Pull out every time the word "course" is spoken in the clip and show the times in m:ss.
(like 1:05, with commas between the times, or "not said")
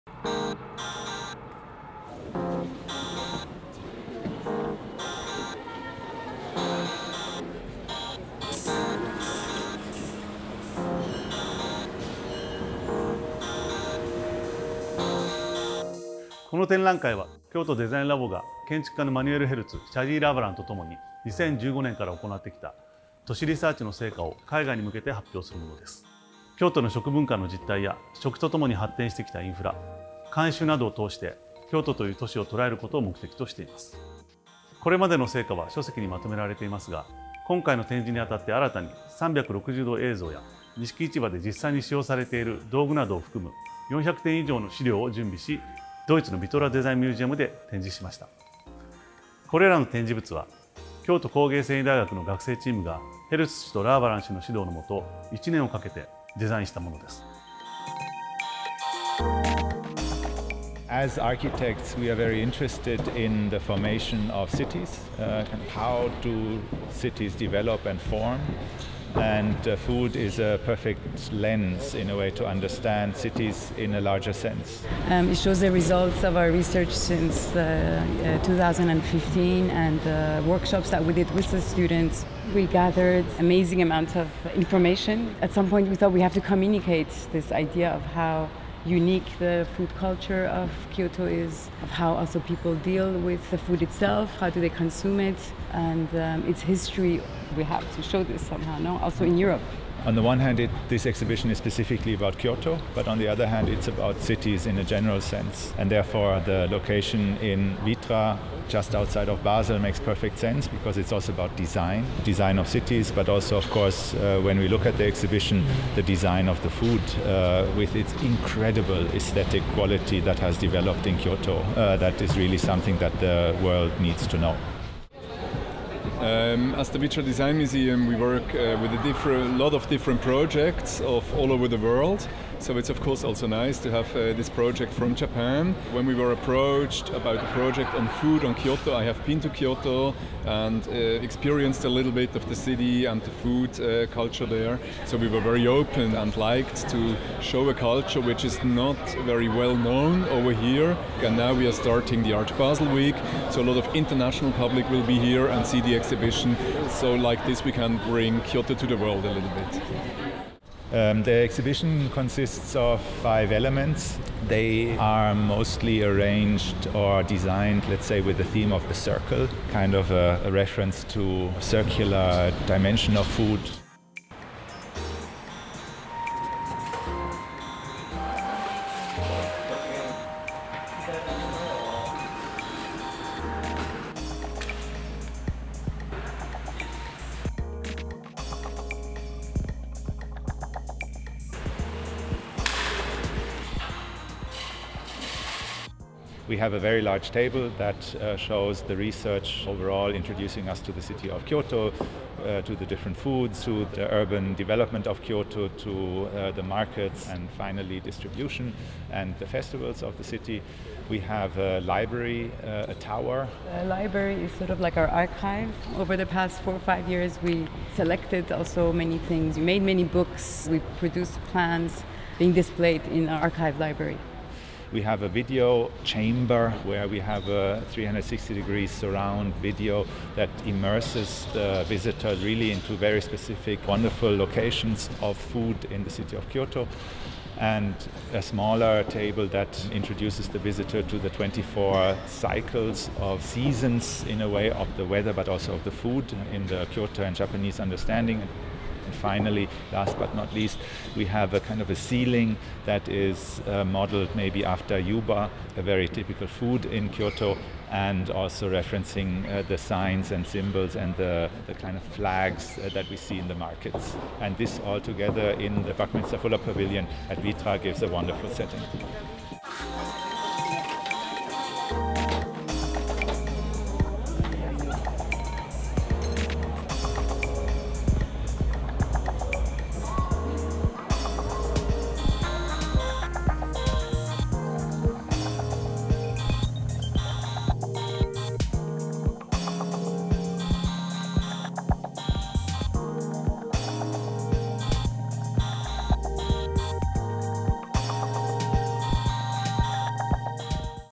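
1:53, 2:13.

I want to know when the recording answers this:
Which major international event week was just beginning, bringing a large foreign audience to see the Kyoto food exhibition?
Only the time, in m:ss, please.
2:32.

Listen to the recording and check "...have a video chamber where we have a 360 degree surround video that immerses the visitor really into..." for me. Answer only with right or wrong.
right.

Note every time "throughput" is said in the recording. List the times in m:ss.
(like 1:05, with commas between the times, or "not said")
not said.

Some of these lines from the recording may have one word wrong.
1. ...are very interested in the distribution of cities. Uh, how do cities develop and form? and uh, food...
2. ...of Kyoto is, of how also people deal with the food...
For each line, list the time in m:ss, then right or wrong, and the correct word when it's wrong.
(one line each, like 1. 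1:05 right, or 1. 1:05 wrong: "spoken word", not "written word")
1. 1:02 wrong: "formation", not "distribution"
2. 1:30 right.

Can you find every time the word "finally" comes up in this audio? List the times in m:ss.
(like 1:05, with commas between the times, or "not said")
3:27, 4:09.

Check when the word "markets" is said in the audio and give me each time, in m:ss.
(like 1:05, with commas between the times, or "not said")
3:26, 4:23.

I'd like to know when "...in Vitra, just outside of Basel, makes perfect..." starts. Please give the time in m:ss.
1:47.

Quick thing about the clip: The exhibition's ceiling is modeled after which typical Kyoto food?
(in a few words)
yuba.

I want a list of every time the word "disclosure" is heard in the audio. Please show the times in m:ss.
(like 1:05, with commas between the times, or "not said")
not said.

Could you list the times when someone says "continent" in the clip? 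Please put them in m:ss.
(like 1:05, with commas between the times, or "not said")
not said.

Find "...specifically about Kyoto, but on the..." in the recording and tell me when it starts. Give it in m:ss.
1:41.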